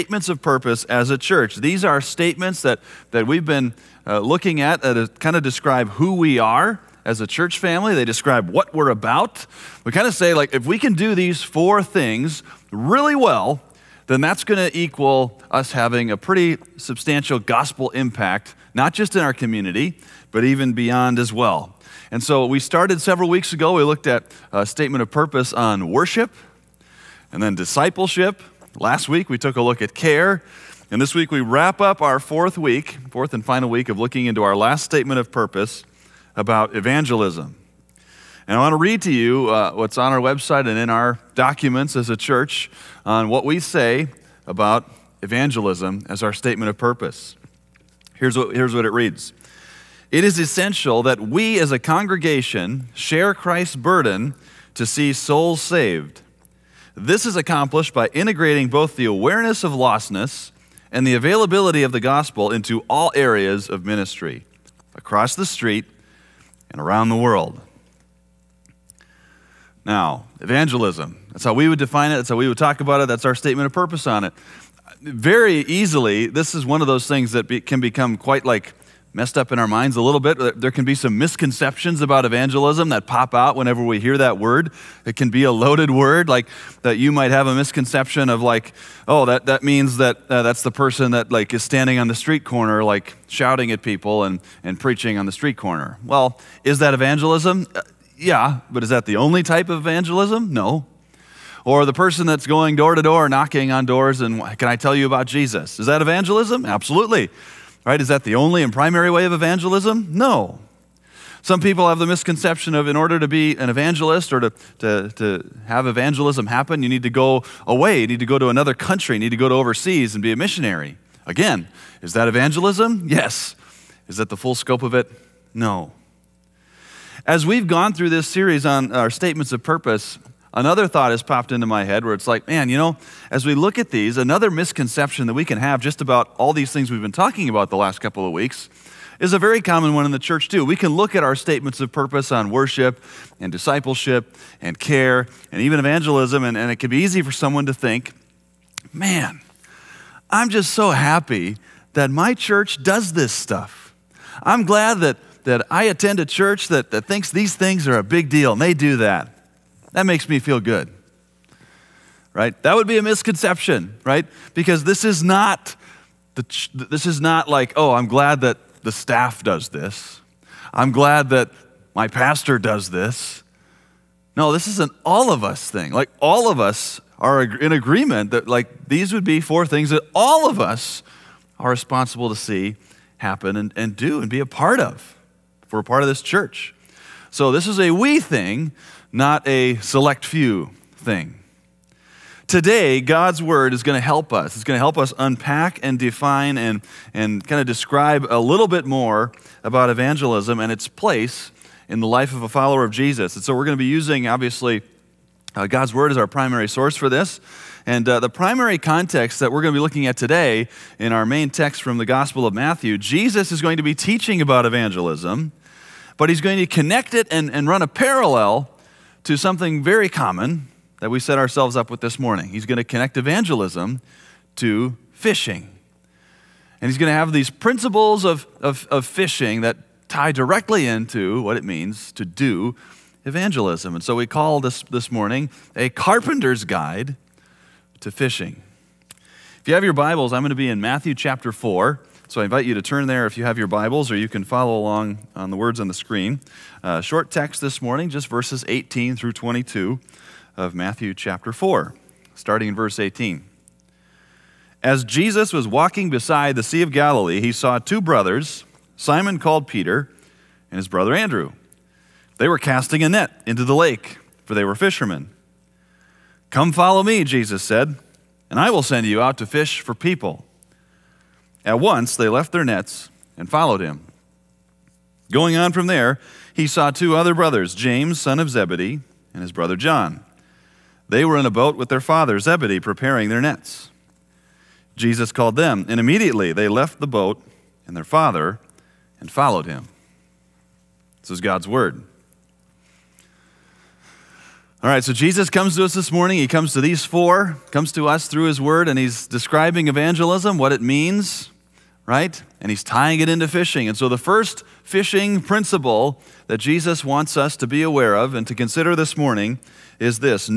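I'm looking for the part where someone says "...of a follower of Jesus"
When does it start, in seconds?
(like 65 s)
202 s.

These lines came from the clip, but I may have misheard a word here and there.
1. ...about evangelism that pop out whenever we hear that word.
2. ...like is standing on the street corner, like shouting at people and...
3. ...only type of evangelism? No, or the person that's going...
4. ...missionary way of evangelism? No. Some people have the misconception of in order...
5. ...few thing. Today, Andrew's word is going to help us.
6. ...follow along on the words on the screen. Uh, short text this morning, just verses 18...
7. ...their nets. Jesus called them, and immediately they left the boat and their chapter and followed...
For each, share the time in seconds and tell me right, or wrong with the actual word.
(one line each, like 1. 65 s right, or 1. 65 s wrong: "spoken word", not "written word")
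1. 82 s right
2. 91 s right
3. 99 s right
4. 108 s wrong: "primary", not "missionary"
5. 190 s wrong: "God", not "Andrew"
6. 244 s right
7. 283 s wrong: "father", not "chapter".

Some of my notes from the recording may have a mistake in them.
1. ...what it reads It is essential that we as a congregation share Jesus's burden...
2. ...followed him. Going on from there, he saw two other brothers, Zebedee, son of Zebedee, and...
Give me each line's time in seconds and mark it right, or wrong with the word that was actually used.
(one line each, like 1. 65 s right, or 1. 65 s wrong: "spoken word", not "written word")
1. 48 s wrong: "Christ", not "Jesus"
2. 273 s wrong: "James", not "Zebedee".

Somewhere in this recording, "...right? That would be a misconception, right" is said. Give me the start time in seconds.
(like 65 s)
162 s.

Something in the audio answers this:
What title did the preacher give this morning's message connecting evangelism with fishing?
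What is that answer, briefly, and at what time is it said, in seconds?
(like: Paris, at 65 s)
A carpenter's guide to fishing, at 235 s.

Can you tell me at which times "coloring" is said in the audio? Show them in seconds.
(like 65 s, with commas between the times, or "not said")
not said.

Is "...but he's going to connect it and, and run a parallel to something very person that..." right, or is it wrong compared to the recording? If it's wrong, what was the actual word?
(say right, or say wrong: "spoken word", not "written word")
wrong: "common", not "person".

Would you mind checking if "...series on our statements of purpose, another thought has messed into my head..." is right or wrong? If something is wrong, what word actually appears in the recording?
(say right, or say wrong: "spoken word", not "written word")
wrong: "popped", not "messed".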